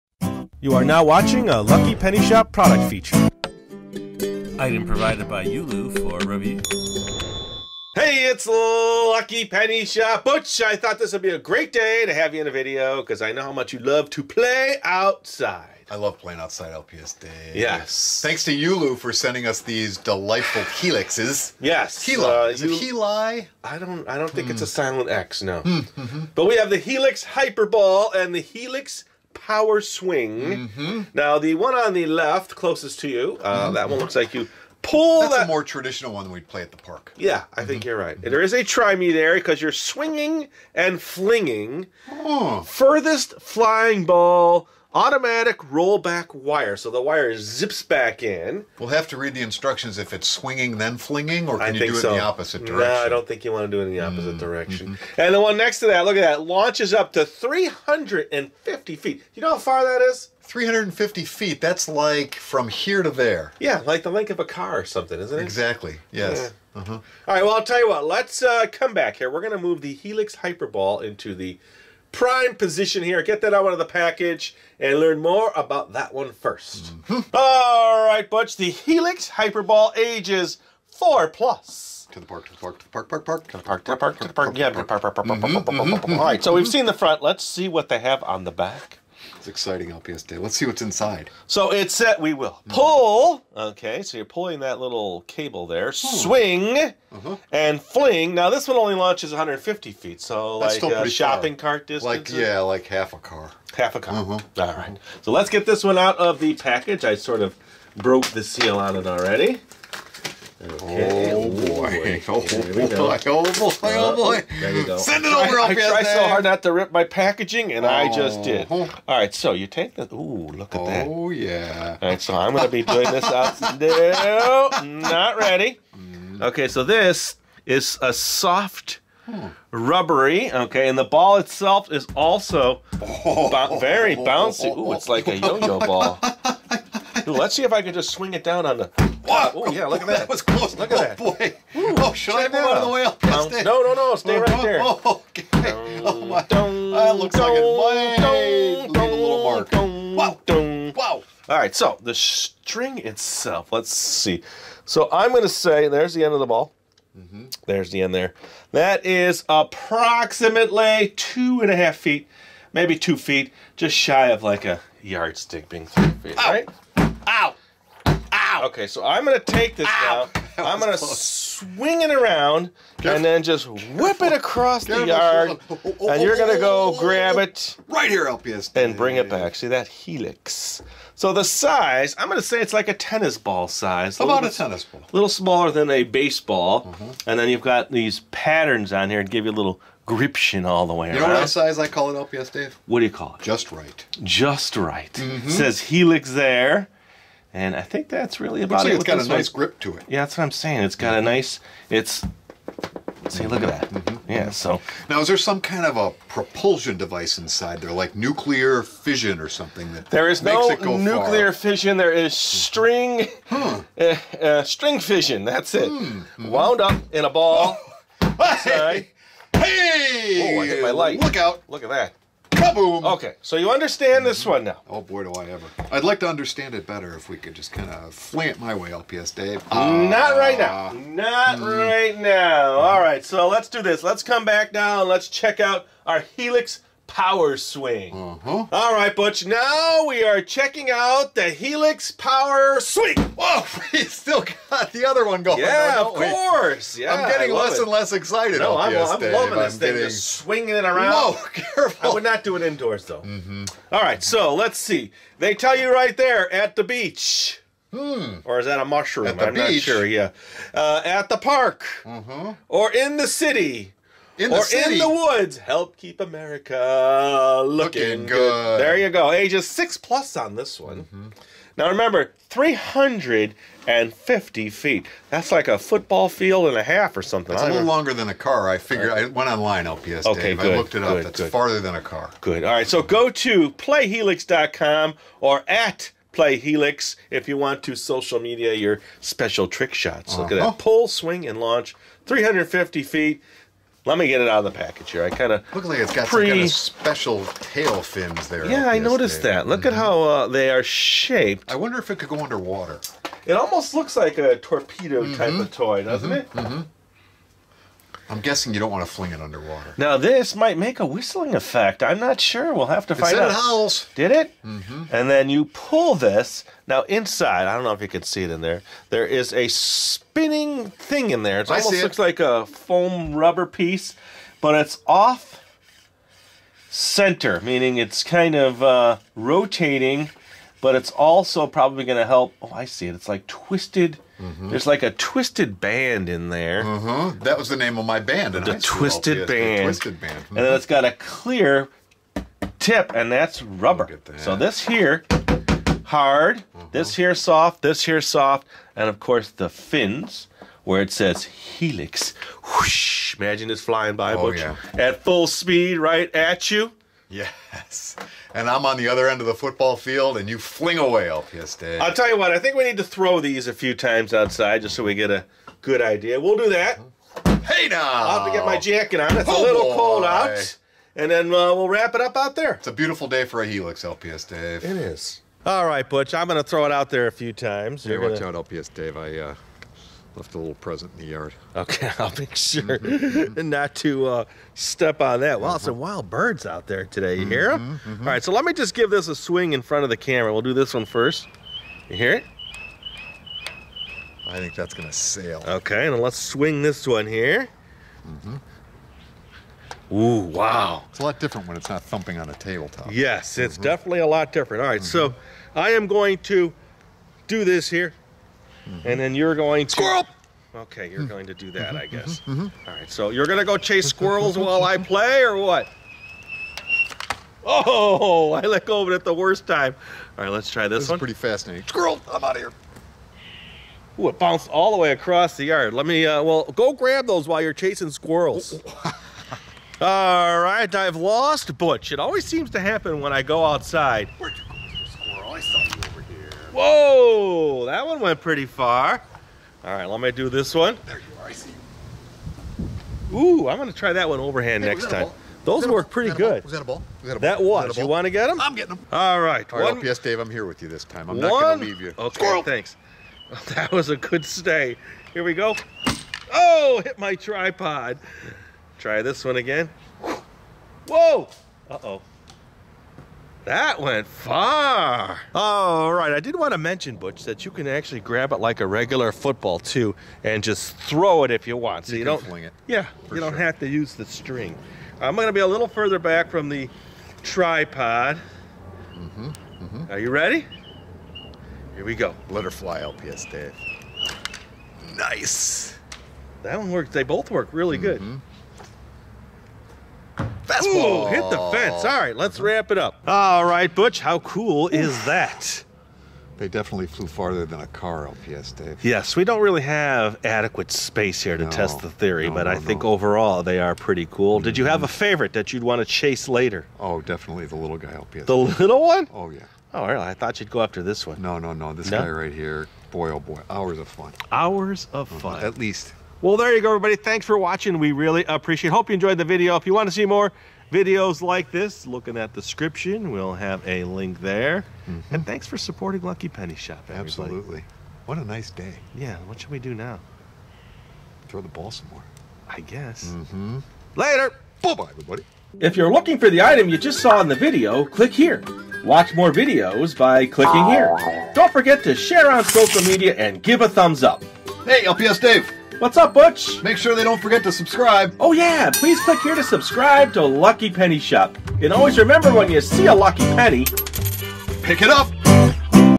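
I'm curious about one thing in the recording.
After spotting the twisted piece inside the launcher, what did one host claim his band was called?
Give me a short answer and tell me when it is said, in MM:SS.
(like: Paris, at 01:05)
The Twisted Band, at 05:39.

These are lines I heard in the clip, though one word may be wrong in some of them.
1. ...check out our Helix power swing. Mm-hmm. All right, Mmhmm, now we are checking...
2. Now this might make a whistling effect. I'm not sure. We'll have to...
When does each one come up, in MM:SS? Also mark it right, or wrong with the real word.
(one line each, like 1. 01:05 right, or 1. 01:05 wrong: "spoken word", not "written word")
1. 03:55 wrong: "Butch", not "Mmhmm"
2. 05:09 right.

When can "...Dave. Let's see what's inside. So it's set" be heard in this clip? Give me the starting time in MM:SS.
01:30.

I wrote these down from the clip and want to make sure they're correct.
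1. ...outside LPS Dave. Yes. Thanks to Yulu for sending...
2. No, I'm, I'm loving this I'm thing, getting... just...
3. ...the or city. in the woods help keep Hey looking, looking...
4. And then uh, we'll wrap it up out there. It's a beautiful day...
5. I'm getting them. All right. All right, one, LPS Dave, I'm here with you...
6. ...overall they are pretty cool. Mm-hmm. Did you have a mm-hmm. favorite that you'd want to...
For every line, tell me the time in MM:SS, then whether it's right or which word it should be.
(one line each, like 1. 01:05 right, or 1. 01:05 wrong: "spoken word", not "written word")
1. 00:16 right
2. 04:08 right
3. 04:24 wrong: "America", not "Hey"
4. 06:11 right
5. 07:28 right
6. 08:23 right.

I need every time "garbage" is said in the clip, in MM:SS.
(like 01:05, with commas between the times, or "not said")
not said.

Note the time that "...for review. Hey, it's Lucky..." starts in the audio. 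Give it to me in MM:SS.
00:05.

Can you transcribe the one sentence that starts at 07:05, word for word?
Let me, uh, well, go grab those while you're chasing squirrels.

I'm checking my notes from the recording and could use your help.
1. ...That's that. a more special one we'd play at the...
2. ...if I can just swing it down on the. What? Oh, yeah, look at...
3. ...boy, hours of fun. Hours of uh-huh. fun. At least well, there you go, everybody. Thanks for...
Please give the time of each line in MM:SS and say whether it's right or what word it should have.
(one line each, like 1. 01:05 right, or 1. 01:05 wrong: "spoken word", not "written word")
1. 00:35 wrong: "traditional", not "special"
2. 02:17 right
3. 08:33 right.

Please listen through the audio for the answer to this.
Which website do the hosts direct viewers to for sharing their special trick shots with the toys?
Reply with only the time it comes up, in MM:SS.
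04:43.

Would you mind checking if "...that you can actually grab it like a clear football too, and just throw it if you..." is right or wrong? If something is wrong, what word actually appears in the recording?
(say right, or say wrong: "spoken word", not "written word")
wrong: "regular", not "clear".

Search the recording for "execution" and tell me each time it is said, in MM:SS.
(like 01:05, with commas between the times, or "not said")
not said.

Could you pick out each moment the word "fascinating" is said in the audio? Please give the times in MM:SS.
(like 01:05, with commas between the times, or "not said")
07:01.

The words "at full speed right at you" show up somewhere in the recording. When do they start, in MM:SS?
05:54.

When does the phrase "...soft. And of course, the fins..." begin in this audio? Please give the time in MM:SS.
05:48.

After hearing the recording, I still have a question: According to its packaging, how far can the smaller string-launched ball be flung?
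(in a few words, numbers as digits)
150 feet.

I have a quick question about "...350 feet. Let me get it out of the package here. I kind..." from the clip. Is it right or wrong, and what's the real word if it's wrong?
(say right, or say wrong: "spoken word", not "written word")
right.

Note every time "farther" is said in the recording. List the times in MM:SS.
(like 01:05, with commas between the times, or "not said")
04:41, 08:17.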